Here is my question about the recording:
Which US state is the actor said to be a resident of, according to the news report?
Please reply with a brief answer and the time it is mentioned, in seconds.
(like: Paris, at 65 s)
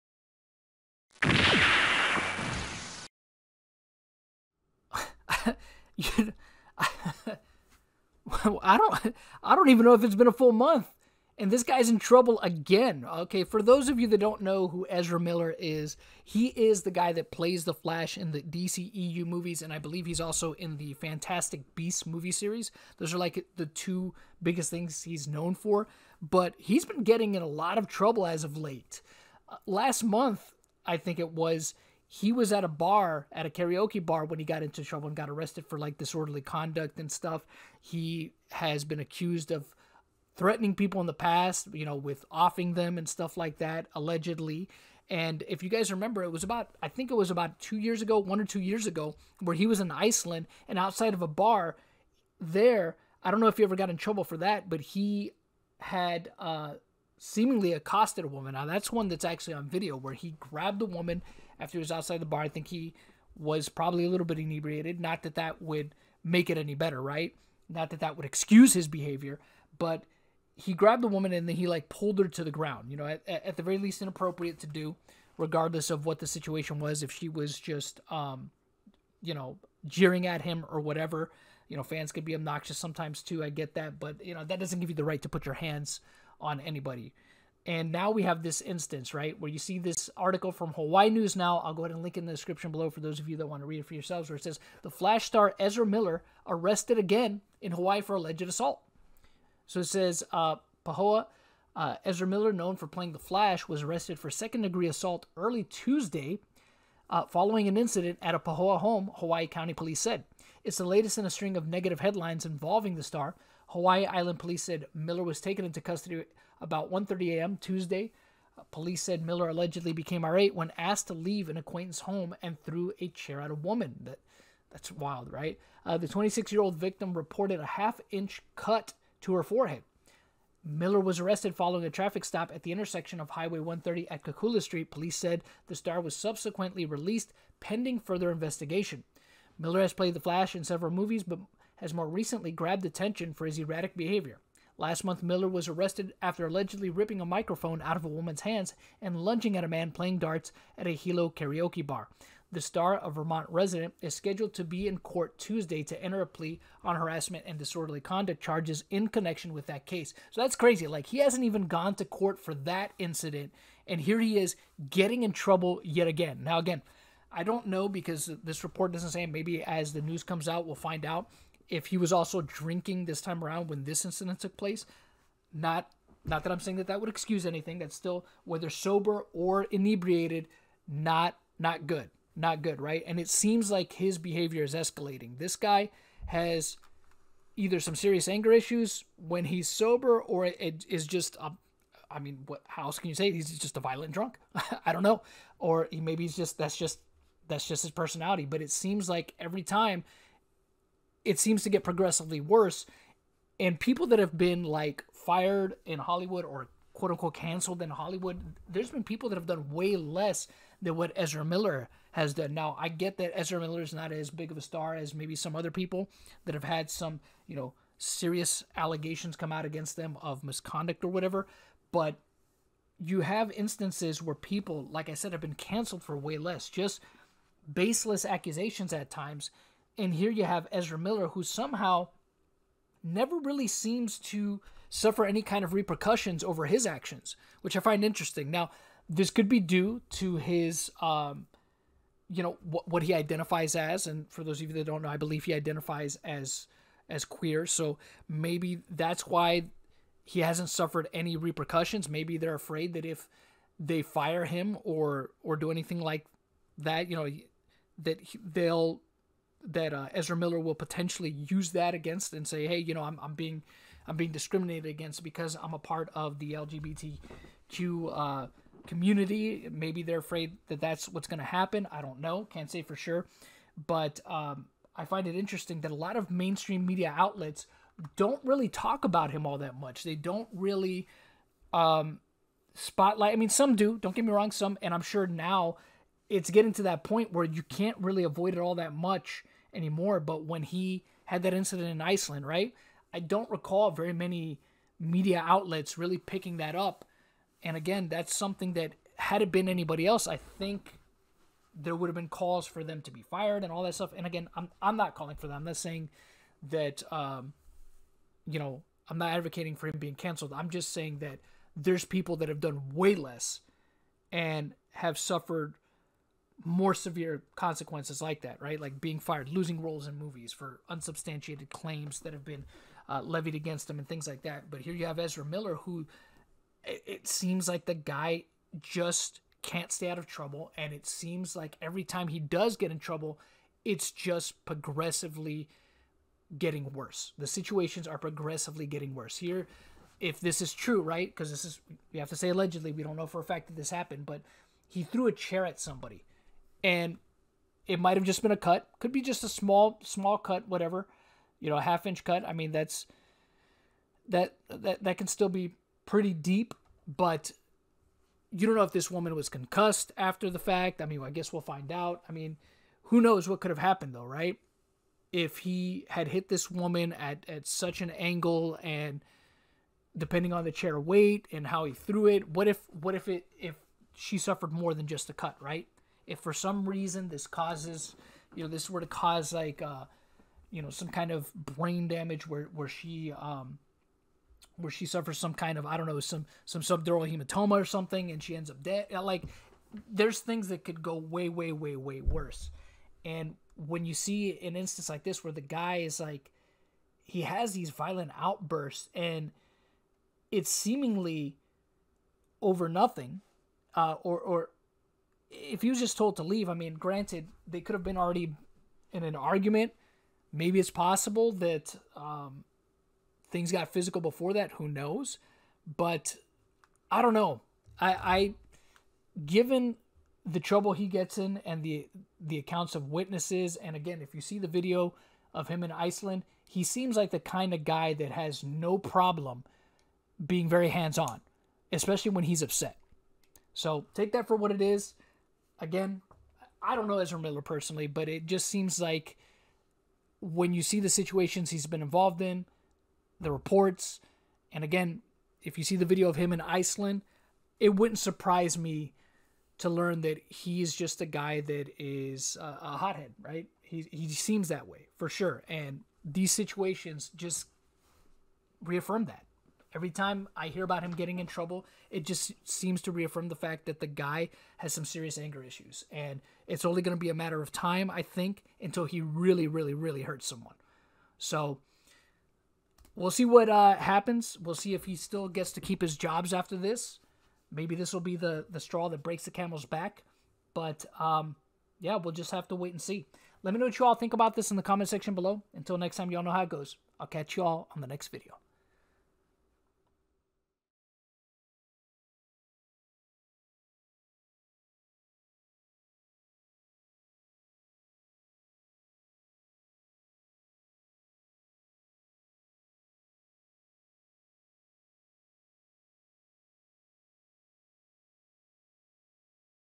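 Vermont, at 153 s.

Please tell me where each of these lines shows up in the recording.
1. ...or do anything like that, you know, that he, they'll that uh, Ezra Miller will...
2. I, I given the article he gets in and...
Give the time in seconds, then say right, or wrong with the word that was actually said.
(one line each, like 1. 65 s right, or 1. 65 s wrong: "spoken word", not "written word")
1. 255 s right
2. 417 s wrong: "trouble", not "article".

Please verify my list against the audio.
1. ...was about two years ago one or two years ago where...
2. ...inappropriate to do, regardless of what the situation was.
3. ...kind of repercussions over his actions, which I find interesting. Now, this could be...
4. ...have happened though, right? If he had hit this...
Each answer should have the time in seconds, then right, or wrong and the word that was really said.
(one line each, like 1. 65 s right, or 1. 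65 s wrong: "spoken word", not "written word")
1. 47 s right
2. 74 s right
3. 235 s right
4. 363 s right.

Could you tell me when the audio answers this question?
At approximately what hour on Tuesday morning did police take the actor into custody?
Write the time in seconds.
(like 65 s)
116 s.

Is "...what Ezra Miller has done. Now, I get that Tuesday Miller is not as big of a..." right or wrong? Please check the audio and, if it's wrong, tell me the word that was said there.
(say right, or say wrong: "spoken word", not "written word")
wrong: "Ezra", not "Tuesday".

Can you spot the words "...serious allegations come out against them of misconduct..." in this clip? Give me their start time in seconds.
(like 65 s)
217 s.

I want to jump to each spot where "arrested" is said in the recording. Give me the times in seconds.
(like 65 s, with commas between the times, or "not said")
35 s, 96 s, 103 s, 131 s, 145 s.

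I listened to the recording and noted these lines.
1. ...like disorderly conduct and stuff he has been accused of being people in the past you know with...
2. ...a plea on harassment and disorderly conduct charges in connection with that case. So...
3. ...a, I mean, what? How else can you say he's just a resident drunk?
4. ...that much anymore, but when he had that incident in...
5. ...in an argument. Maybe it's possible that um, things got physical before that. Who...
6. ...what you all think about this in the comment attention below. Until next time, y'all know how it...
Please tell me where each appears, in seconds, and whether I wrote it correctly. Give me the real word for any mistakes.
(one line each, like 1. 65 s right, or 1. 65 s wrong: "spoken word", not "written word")
1. 35 s wrong: "threatening", not "being"
2. 156 s right
3. 191 s wrong: "violent", not "resident"
4. 288 s right
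5. 409 s right
6. 483 s wrong: "section", not "attention".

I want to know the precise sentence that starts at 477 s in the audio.
Maybe this will be the, the straw that breaks the camel's back.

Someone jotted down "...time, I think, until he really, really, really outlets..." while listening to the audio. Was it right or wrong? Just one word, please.
wrong.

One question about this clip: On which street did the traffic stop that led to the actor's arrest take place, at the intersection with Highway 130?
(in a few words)
Kakula Street.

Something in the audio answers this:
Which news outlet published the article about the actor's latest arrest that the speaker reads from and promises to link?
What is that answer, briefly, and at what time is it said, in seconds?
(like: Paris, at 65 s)
Hawaii News Now, at 90 s.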